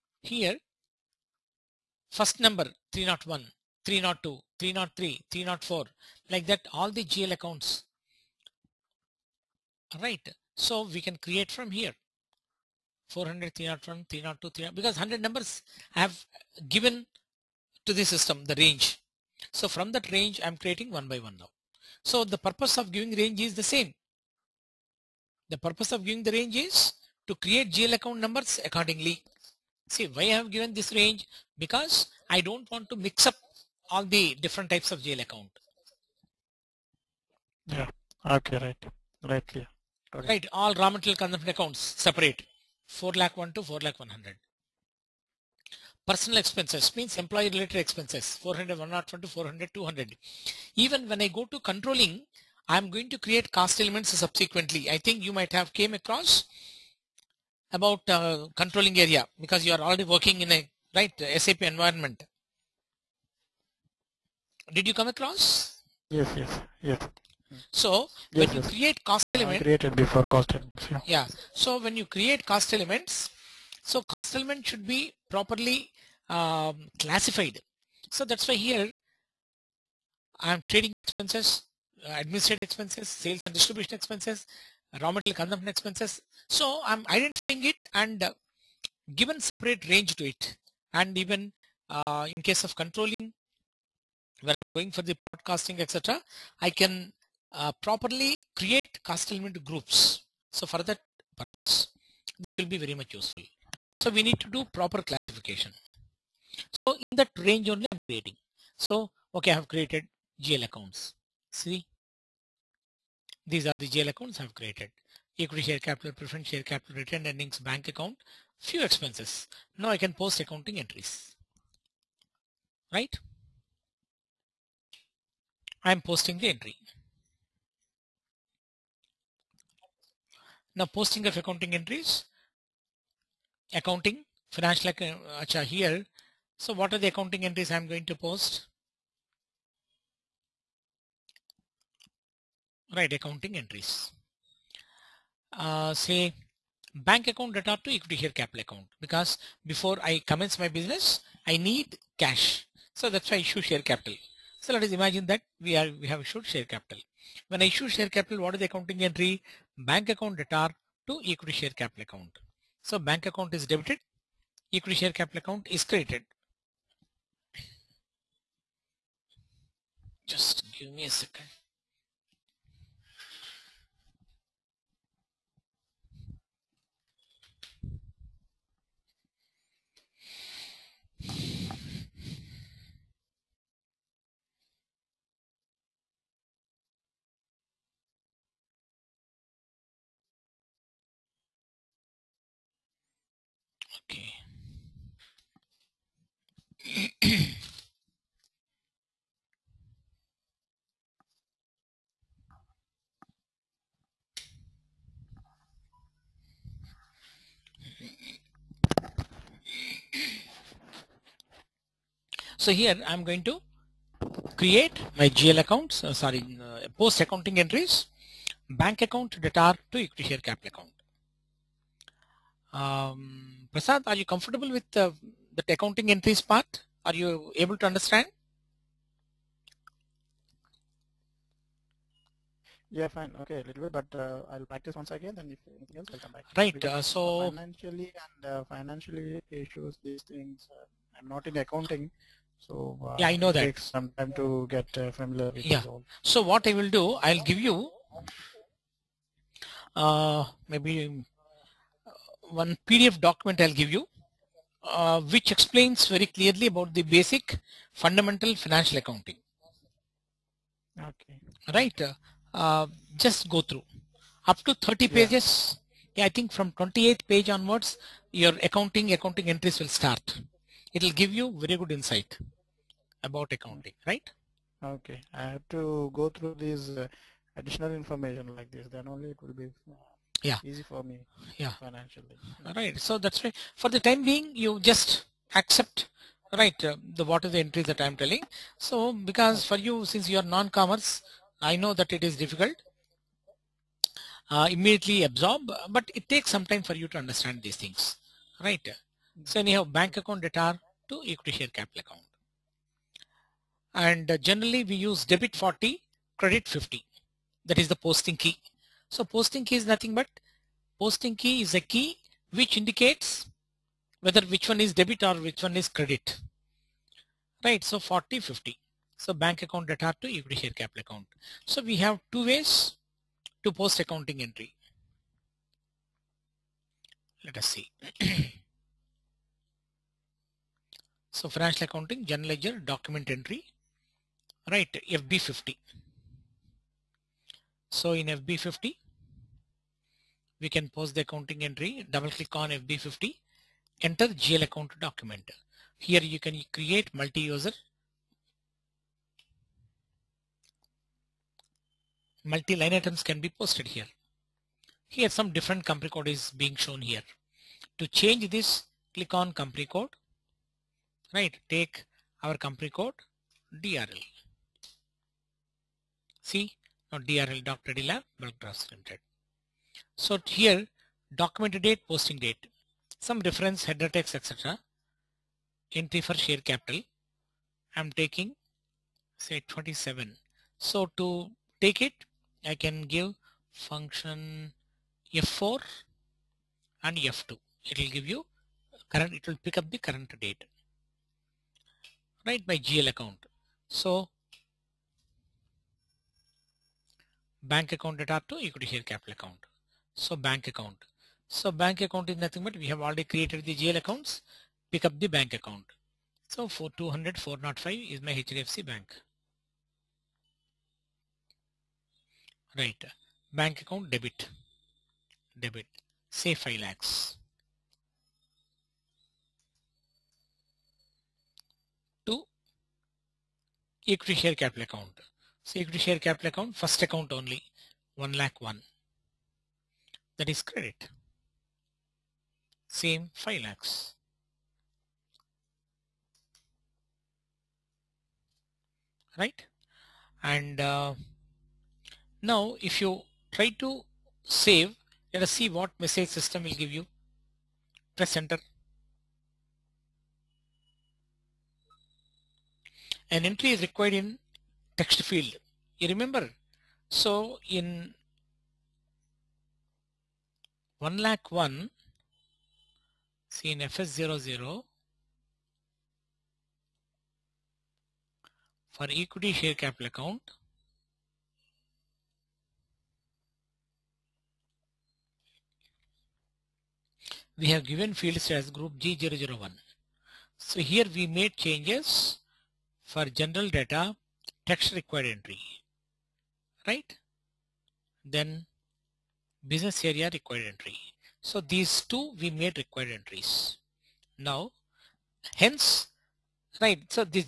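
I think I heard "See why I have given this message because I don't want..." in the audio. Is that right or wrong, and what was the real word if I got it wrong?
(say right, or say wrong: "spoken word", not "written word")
wrong: "range", not "message".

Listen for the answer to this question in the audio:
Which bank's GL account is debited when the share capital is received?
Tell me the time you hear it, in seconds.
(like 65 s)
408 s.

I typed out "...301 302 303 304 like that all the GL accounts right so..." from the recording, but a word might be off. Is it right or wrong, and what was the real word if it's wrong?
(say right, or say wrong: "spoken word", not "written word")
right.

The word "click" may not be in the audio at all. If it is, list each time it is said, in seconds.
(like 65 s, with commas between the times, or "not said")
342 s, 359 s.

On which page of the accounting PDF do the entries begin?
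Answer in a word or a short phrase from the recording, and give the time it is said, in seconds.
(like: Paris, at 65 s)
28, at 266 s.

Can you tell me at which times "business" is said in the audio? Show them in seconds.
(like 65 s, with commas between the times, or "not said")
150 s, 489 s.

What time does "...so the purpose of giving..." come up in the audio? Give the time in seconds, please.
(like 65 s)
22 s.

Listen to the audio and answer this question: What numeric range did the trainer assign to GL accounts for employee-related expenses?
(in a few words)
400101 to 400200.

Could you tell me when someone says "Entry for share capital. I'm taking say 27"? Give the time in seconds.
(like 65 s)
375 s.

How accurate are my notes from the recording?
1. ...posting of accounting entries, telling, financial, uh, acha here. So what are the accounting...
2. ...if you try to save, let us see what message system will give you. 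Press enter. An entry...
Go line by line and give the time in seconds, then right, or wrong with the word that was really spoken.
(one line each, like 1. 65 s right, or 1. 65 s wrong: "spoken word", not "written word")
1. 130 s wrong: "accounting", not "telling"
2. 442 s right.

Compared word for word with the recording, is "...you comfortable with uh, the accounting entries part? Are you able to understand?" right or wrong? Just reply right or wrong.
right.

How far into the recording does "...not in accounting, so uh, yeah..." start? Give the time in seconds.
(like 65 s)
241 s.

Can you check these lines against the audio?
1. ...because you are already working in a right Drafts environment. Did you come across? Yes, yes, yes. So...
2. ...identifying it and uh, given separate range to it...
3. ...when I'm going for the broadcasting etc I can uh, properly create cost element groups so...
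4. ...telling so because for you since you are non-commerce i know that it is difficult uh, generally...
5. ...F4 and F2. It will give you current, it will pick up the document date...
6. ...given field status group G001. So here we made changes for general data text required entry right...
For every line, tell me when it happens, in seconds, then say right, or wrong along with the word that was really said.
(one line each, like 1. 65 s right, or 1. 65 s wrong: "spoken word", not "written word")
1. 59 s wrong: "SAP", not "Drafts"
2. 87 s right
3. 94 s right
4. 288 s wrong: "immediately", not "generally"
5. 385 s wrong: "current", not "document"
6. 477 s right.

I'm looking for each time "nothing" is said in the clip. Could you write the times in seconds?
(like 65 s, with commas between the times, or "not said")
309 s, 402 s.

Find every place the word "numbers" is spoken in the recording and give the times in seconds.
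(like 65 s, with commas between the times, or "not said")
2 s, 15 s, 28 s.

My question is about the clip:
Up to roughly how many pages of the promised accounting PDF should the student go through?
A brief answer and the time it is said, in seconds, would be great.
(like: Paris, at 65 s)
30, at 264 s.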